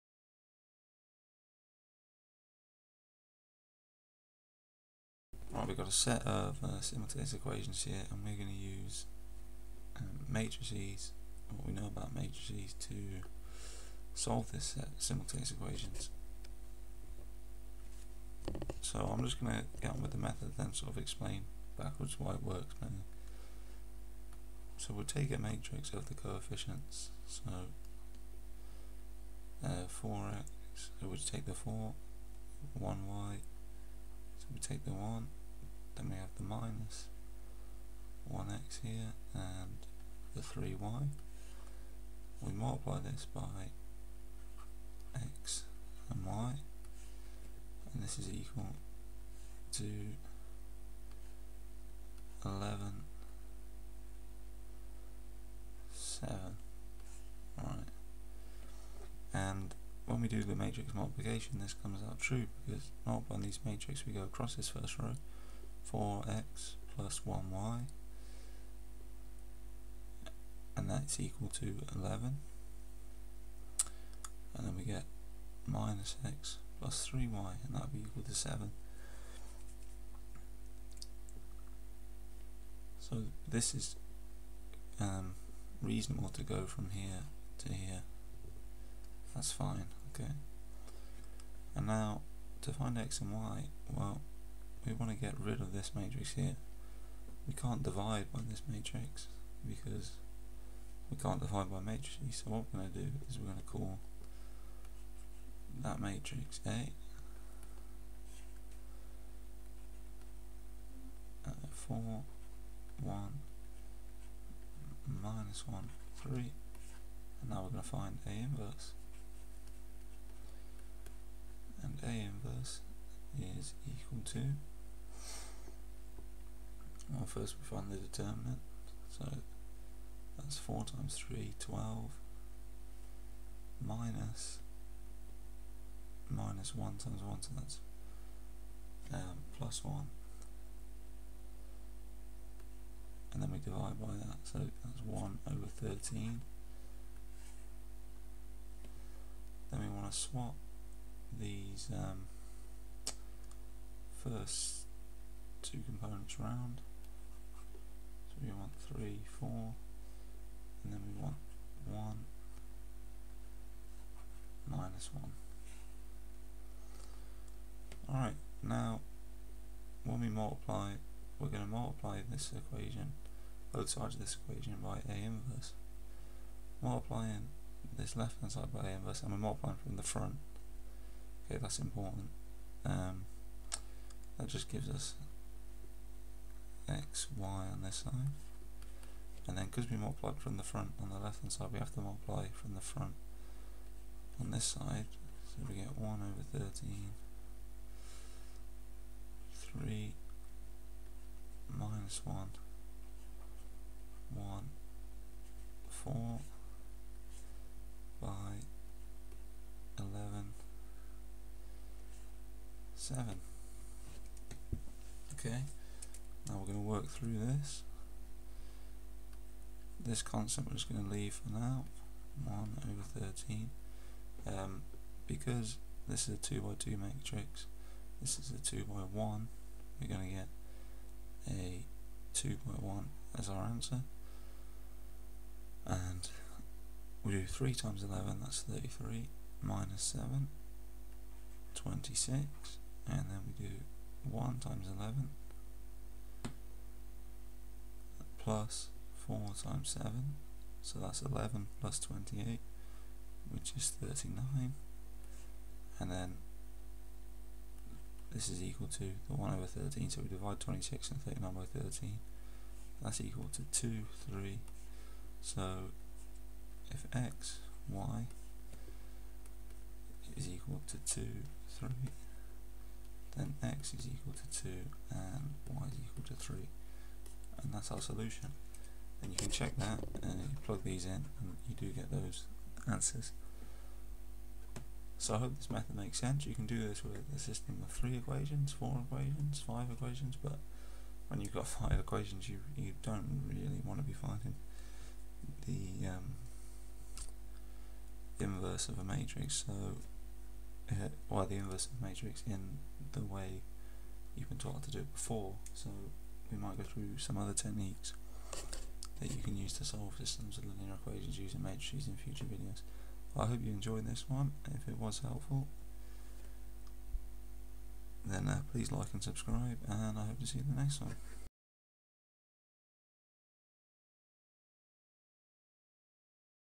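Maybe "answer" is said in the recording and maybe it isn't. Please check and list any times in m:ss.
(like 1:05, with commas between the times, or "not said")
3:53, 4:42.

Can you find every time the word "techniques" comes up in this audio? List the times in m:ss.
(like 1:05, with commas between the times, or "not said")
5:07.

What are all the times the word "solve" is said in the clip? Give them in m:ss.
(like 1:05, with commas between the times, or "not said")
0:14, 5:09.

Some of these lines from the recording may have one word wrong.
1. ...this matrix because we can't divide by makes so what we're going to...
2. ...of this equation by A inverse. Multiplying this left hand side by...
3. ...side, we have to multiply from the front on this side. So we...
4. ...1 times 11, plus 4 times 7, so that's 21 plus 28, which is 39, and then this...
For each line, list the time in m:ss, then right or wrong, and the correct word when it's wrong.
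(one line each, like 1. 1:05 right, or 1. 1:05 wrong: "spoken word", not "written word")
1. 1:38 wrong: "matrices", not "makes"
2. 2:54 right
3. 3:11 right
4. 4:04 wrong: "11", not "21".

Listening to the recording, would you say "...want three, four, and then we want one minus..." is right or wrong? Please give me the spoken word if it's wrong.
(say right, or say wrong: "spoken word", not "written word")
right.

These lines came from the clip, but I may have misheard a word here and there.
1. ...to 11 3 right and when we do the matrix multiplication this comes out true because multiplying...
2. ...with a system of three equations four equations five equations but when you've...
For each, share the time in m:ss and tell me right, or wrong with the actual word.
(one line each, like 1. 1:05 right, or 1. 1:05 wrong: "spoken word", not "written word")
1. 0:49 wrong: "7", not "3"
2. 4:47 right.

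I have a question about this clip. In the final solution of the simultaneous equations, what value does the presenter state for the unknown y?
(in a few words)
3.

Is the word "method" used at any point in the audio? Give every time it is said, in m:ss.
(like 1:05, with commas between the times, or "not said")
0:20, 4:45.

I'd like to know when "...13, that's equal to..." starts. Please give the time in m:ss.
4:21.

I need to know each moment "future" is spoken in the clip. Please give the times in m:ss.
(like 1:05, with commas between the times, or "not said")
5:12.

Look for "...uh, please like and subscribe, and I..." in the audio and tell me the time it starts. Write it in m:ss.
5:18.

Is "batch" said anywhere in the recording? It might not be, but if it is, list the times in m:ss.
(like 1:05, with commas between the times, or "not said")
not said.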